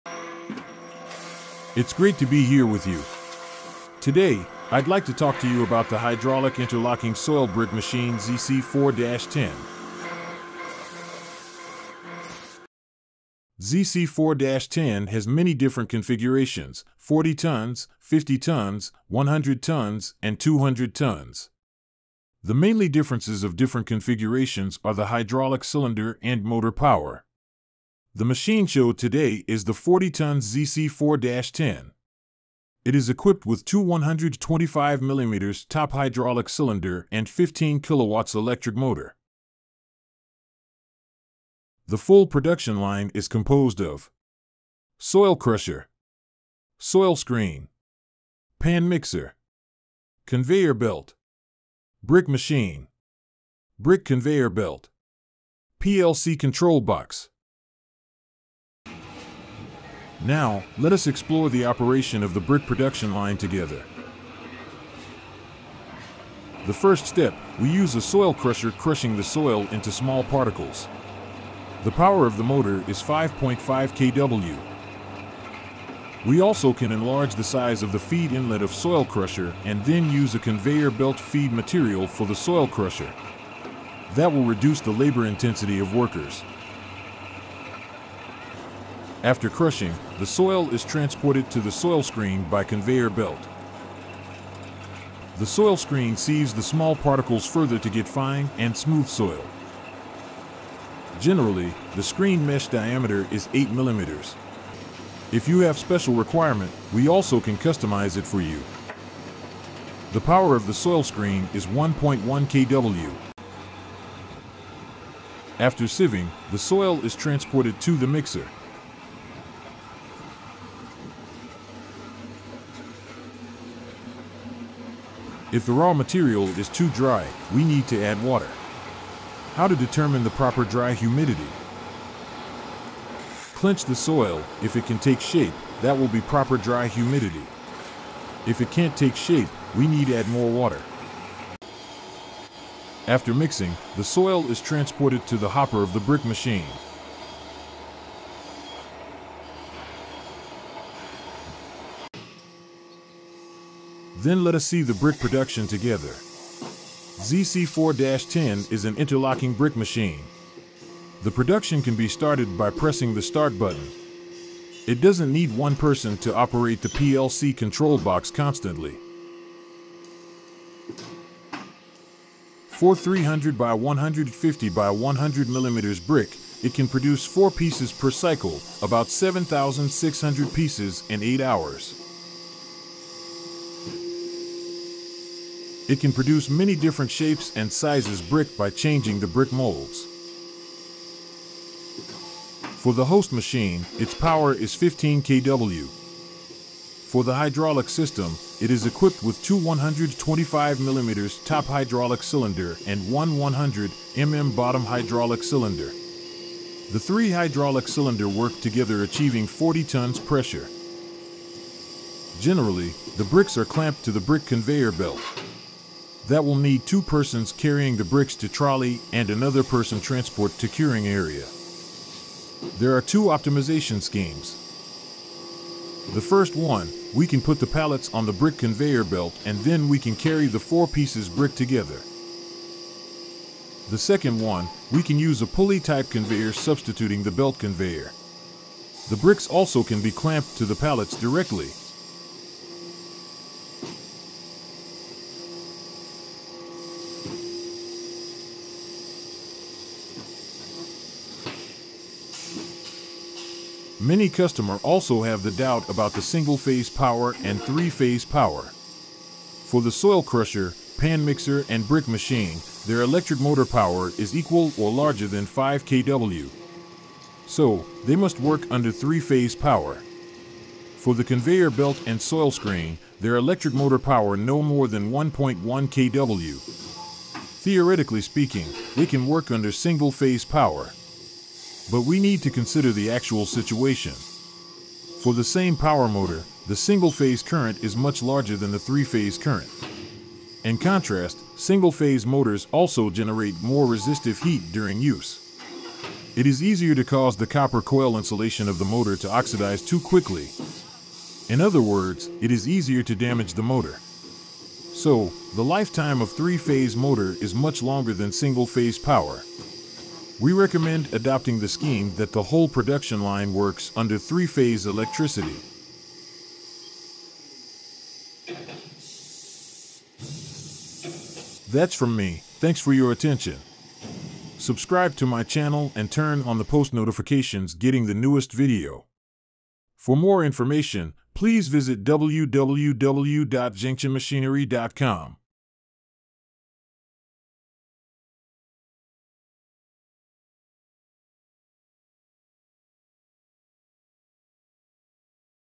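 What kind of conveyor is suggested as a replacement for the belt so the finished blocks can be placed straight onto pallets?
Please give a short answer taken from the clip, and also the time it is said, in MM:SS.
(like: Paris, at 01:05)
pulley type conveyor, at 03:55.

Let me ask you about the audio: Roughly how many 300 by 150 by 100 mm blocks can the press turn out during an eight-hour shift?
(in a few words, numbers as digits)
7,600.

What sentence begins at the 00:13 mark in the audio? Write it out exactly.
ZC4-10 has many different configurations, 40 tons, 50 tons, 100 tons, and 200 tons.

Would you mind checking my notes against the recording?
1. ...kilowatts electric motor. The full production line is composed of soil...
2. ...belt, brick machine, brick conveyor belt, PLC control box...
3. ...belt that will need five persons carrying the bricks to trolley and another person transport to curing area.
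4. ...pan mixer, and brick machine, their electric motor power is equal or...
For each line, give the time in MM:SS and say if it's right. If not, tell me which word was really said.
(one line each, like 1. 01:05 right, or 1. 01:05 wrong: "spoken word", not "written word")
1. 00:37 right
2. 00:50 right
3. 03:34 wrong: "two", not "five"
4. 04:20 right.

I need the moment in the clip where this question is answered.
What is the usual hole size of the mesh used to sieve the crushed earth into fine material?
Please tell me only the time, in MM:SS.
01:43.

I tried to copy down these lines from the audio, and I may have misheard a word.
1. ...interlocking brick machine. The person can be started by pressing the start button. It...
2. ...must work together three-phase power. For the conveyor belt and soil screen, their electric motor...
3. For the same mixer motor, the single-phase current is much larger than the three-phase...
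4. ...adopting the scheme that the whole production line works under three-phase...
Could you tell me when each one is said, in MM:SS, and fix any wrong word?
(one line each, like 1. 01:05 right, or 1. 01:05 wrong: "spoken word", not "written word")
1. 02:38 wrong: "production", not "person"
2. 04:28 wrong: "under", not "together"
3. 04:45 wrong: "power", not "mixer"
4. 05:11 right.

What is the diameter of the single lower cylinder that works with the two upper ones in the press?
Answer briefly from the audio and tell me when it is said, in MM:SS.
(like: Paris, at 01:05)
100mm, at 03:23.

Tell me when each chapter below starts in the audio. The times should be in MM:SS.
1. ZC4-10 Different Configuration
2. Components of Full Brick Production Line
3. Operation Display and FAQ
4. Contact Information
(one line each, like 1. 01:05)
1. 00:13
2. 00:41
3. 01:00
4. 05:21.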